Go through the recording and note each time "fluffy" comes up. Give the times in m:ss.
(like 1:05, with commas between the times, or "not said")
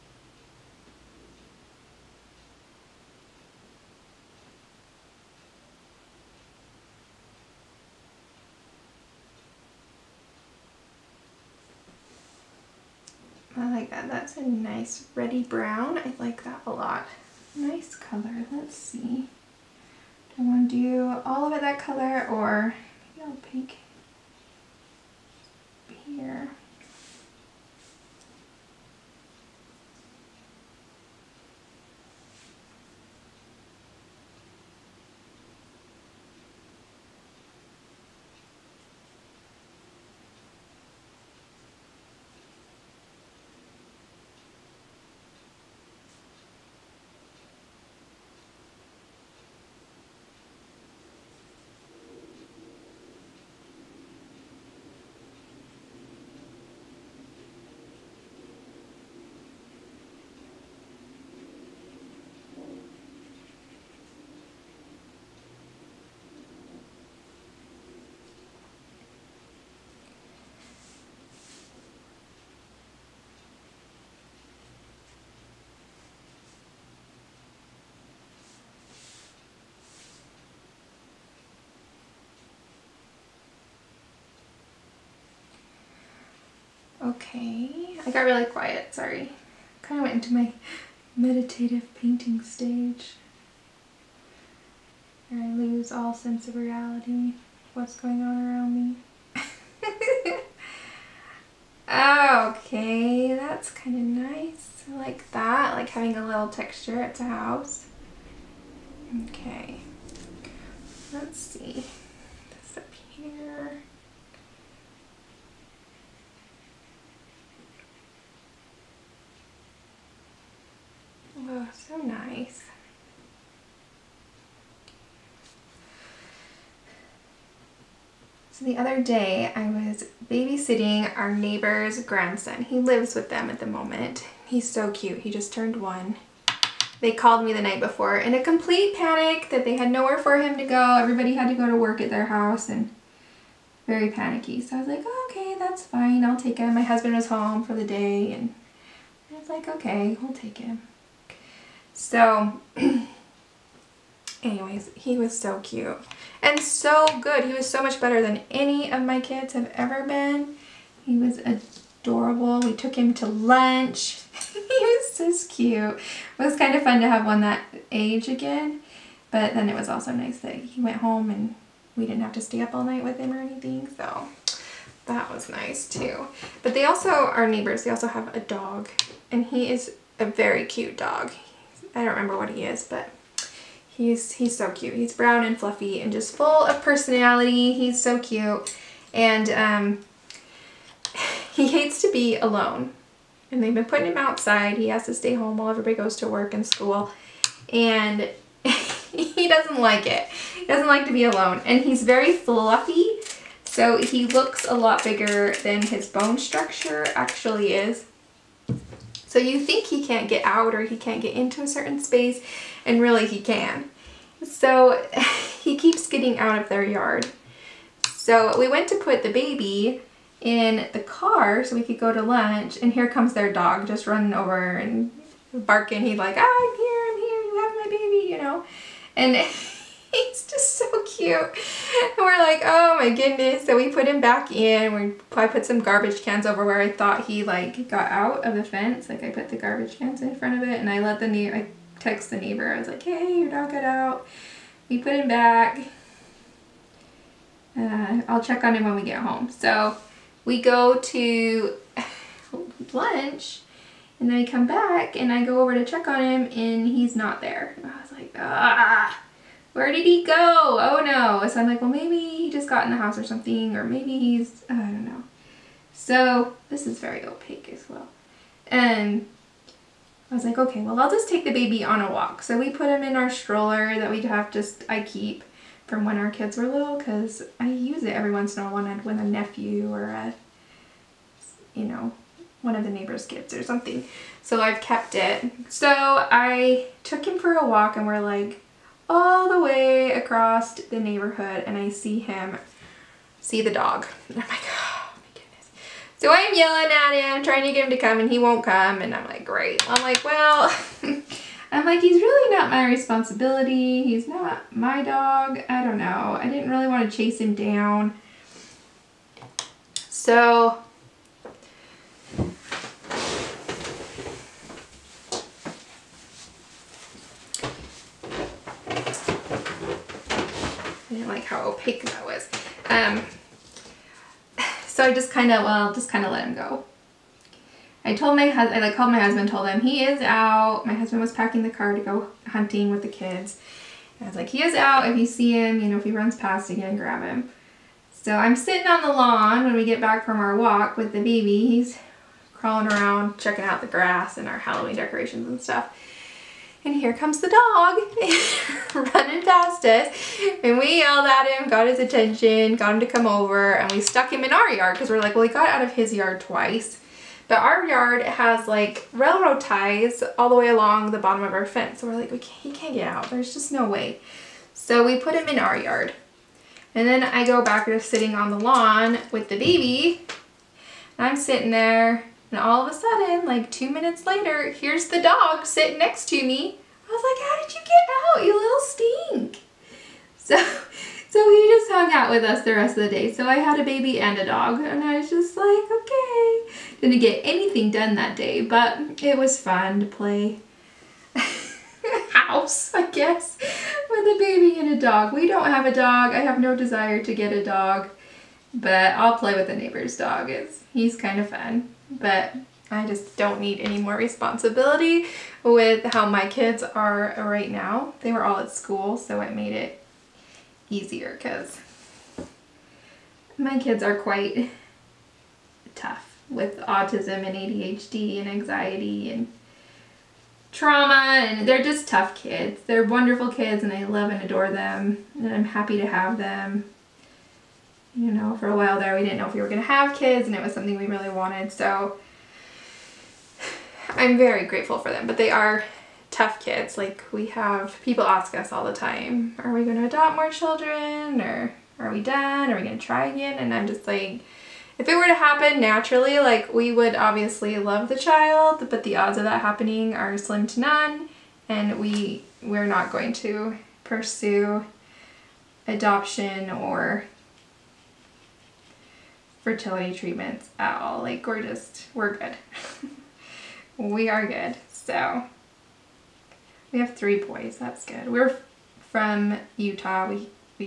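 3:05, 3:22.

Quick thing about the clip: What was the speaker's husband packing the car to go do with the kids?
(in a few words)
hunting.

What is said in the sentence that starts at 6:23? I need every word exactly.
So I had a baby and a dog, and I was just like, okay.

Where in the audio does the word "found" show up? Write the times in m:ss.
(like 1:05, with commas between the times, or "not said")
not said.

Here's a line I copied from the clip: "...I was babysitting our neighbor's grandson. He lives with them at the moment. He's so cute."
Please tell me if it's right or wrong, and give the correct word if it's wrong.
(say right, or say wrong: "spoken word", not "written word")
right.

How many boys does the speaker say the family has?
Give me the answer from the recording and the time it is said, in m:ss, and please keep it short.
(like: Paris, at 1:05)
3, at 7:47.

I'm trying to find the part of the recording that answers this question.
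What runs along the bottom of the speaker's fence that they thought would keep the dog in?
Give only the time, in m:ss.
5:59.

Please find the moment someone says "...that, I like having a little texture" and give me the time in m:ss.
1:45.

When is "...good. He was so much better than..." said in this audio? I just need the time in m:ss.
2:37.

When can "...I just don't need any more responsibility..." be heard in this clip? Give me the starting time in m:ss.
6:42.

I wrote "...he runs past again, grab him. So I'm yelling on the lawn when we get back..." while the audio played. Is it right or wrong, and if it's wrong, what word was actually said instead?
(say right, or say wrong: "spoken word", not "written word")
wrong: "sitting", not "yelling".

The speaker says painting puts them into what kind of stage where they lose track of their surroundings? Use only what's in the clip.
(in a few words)
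meditative painting stage.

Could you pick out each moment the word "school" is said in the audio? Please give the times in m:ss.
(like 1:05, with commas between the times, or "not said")
3:16, 6:48.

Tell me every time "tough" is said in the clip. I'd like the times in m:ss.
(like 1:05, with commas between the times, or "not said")
6:55, 7:02, 7:16.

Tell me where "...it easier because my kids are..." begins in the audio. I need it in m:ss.
6:49.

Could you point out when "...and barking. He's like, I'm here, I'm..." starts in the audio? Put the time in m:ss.
3:44.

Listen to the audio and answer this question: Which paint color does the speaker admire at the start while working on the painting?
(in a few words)
ready brown.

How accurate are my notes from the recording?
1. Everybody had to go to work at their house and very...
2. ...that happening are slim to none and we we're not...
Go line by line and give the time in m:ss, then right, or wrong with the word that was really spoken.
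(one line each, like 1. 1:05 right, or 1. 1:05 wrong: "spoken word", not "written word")
1. 2:20 right
2. 7:29 right.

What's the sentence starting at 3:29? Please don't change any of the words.
So you think he can't get out or he can't get into a certain space, and really he can.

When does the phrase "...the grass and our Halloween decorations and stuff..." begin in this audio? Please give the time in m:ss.
5:43.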